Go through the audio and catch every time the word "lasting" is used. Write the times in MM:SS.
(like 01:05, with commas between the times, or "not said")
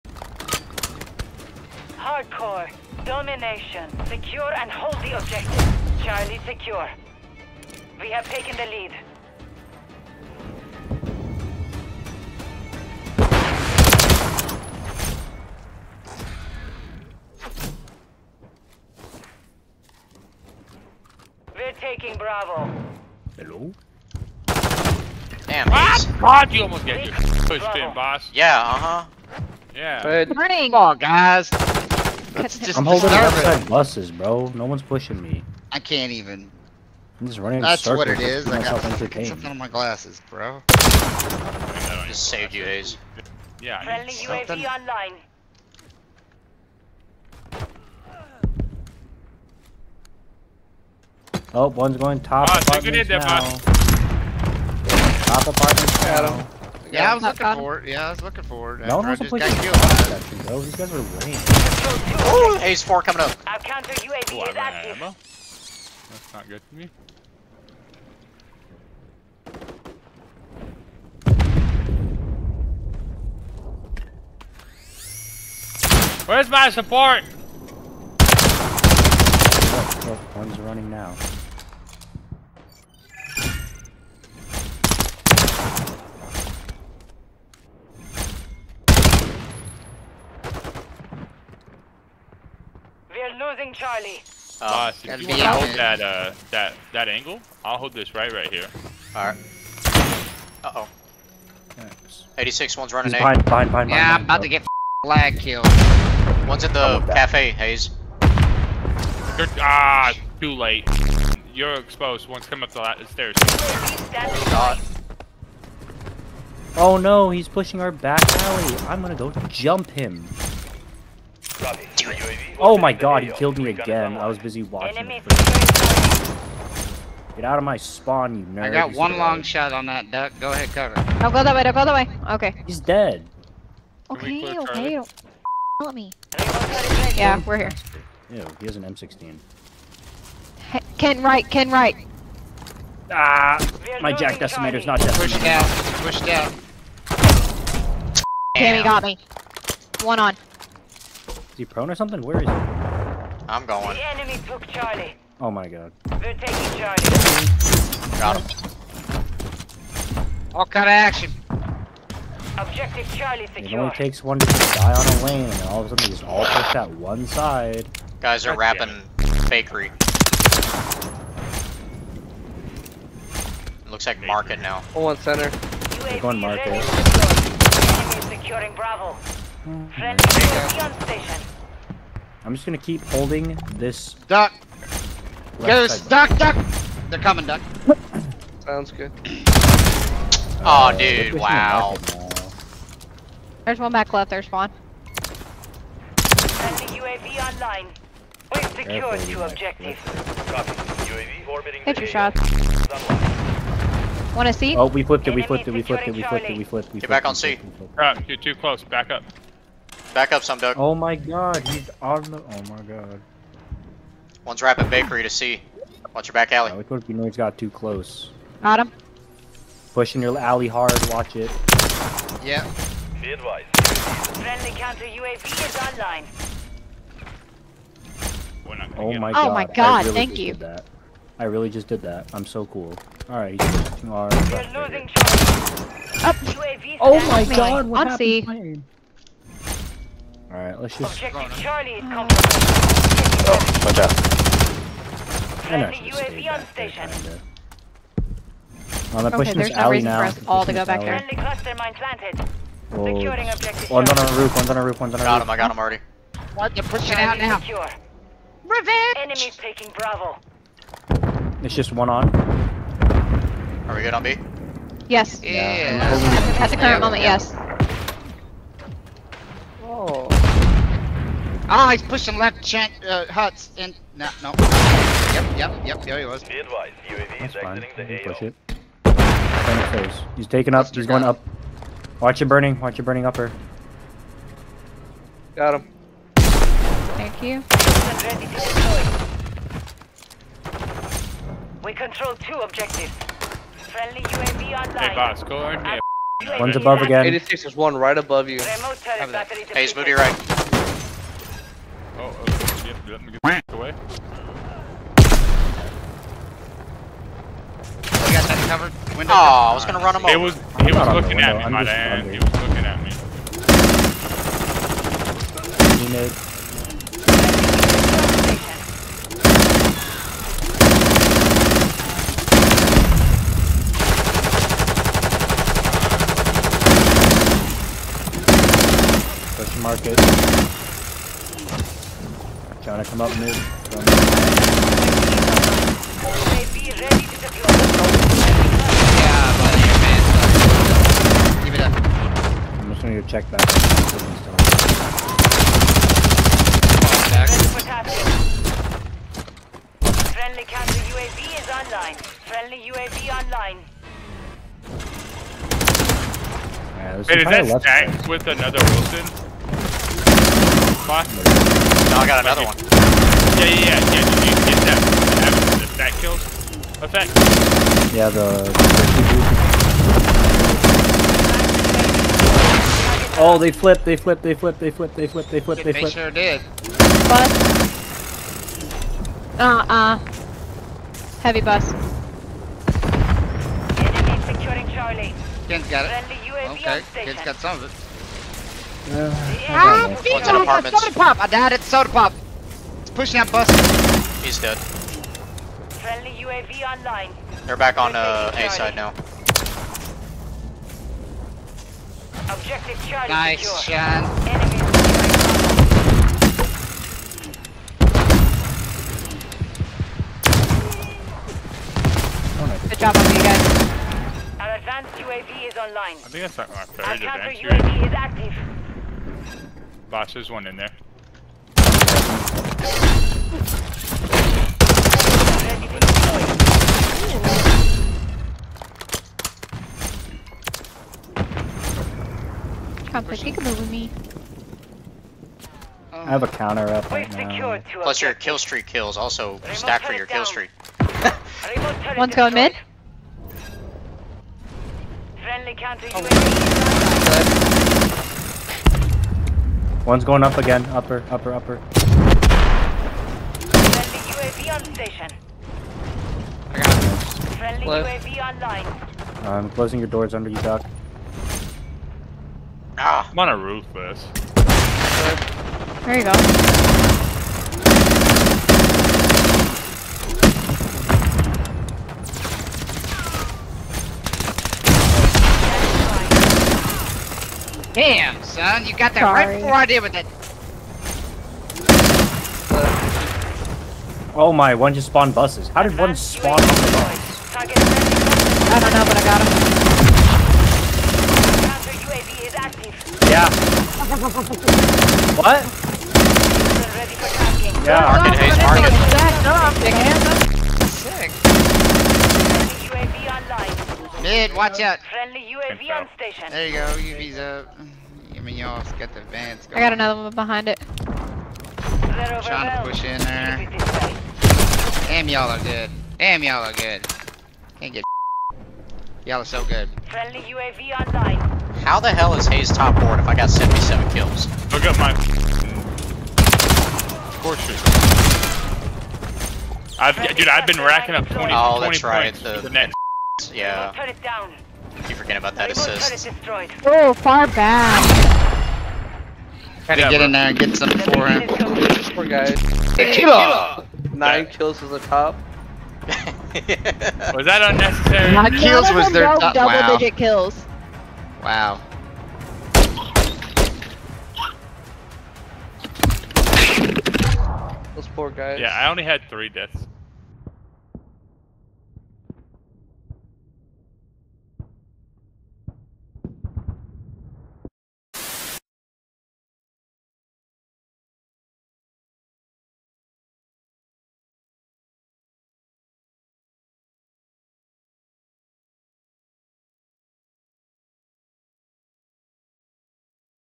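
not said.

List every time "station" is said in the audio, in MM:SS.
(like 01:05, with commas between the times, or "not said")
03:01, 04:06, 07:34, 08:26.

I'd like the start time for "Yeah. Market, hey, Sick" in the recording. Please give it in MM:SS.
08:17.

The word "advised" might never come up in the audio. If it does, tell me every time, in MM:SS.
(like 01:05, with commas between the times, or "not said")
03:43, 04:36.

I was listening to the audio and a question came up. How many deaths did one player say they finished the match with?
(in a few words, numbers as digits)
3.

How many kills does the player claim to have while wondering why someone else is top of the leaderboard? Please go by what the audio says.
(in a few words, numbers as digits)
77.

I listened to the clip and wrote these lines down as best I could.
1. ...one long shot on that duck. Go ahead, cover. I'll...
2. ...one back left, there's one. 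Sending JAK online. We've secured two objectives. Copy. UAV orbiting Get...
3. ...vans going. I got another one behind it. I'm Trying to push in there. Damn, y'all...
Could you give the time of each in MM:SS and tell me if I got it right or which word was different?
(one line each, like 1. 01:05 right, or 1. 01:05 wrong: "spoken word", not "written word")
1. 02:08 right
2. 03:13 wrong: "UAV", not "JAK"
3. 08:29 right.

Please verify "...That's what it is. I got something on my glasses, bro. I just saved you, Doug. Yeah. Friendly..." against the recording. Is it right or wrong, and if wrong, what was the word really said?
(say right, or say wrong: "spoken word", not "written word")
wrong: "Haze", not "Doug".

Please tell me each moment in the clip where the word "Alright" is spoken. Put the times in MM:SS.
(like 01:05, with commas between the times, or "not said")
01:39, 03:53, 04:00.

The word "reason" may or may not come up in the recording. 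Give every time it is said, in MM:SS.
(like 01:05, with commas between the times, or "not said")
04:10.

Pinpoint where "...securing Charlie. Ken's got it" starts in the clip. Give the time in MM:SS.
06:24.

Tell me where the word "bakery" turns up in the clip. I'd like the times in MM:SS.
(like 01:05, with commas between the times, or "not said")
02:49, 03:34.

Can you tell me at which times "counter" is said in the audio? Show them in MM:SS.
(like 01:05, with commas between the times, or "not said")
01:03, 03:44, 05:50, 07:16, 07:25.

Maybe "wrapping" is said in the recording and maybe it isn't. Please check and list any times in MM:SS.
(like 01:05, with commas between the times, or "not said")
02:48, 03:34.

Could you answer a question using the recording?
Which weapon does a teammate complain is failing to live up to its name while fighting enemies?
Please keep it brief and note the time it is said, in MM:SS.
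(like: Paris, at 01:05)
JAK Decimator, at 02:24.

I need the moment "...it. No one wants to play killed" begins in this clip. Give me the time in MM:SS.
00:58.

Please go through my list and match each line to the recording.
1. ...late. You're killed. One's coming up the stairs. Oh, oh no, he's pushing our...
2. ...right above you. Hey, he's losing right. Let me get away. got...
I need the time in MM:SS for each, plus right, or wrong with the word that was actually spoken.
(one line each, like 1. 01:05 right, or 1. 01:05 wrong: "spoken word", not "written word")
1. 01:50 wrong: "exposed", not "killed"
2. 04:57 wrong: "moving", not "losing".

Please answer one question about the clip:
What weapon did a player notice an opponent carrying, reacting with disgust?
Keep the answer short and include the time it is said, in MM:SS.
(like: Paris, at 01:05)
M16, at 02:18.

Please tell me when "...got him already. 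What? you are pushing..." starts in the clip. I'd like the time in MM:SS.
04:15.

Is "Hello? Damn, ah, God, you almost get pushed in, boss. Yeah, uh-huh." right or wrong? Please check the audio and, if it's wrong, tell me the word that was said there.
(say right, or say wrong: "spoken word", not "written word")
right.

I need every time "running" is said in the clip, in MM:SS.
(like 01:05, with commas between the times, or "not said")
00:37, 01:20, 01:42.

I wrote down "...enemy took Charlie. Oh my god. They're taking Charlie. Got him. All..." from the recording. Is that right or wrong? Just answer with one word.
right.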